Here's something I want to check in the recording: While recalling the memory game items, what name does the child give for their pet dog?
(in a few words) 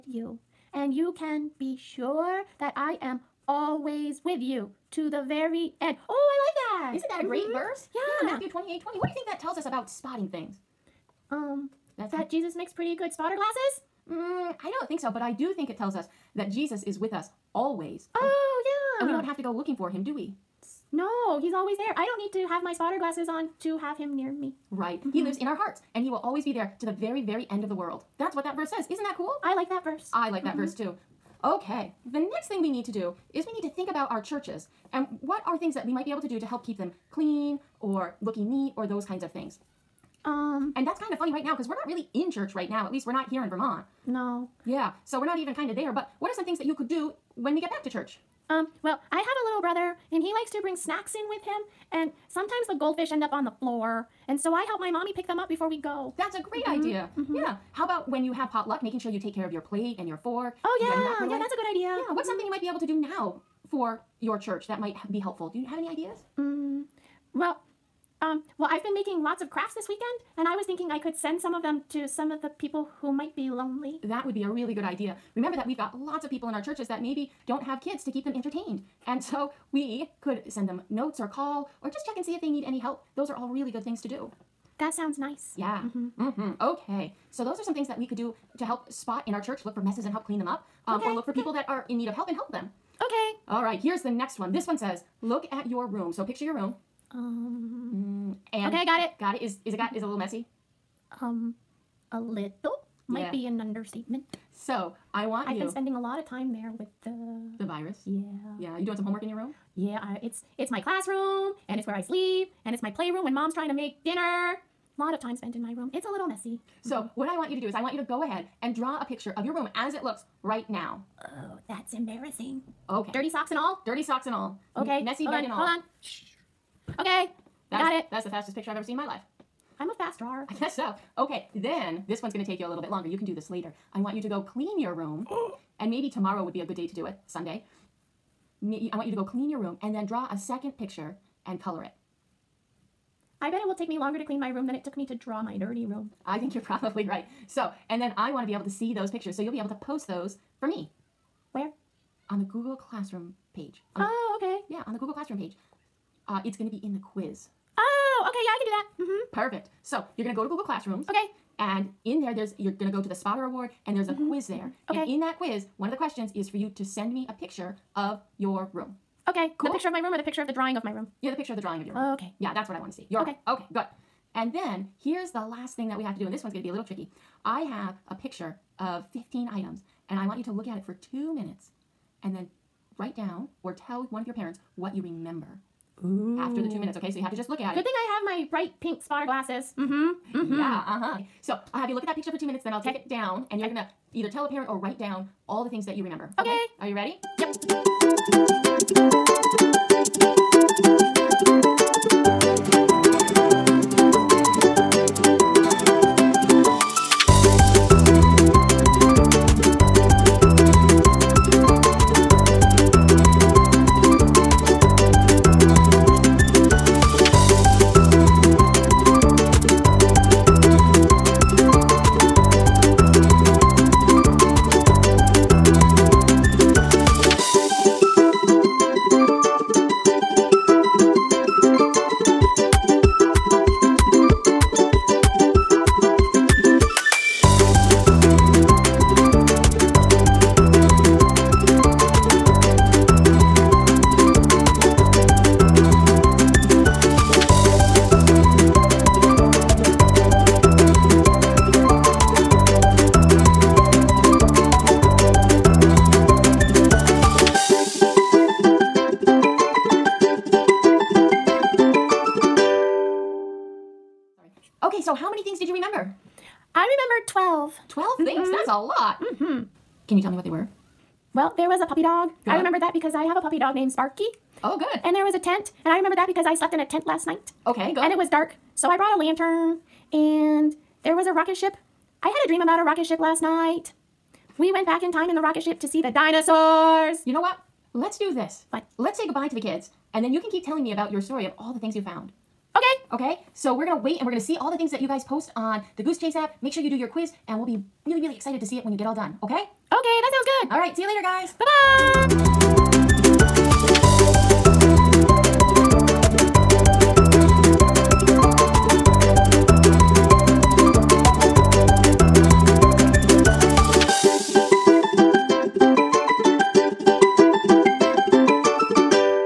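Sparky.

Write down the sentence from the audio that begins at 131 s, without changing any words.
Okay, then this one's going to take you a little bit longer.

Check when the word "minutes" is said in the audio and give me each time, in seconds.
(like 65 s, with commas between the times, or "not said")
181 s, 186 s, 192 s.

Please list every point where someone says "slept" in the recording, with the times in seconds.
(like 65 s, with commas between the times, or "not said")
276 s.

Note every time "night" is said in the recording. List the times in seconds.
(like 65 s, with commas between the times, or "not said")
277 s, 283 s.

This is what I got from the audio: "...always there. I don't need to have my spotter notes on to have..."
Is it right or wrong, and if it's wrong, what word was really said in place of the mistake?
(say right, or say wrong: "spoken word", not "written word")
wrong: "glasses", not "notes".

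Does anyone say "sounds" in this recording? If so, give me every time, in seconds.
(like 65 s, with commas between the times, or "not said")
84 s, 300 s.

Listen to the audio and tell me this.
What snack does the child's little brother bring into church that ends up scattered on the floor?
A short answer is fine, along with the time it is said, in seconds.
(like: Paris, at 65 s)
goldfish, at 52 s.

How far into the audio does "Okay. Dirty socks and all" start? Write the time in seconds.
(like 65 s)
122 s.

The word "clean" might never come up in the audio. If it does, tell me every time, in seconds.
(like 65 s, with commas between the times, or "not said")
37 s, 90 s, 134 s, 139 s, 144 s.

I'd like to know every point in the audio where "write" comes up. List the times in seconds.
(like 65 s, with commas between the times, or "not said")
182 s, 194 s.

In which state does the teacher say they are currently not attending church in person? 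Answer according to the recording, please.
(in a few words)
Vermont.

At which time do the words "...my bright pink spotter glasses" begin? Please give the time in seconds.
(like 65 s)
188 s.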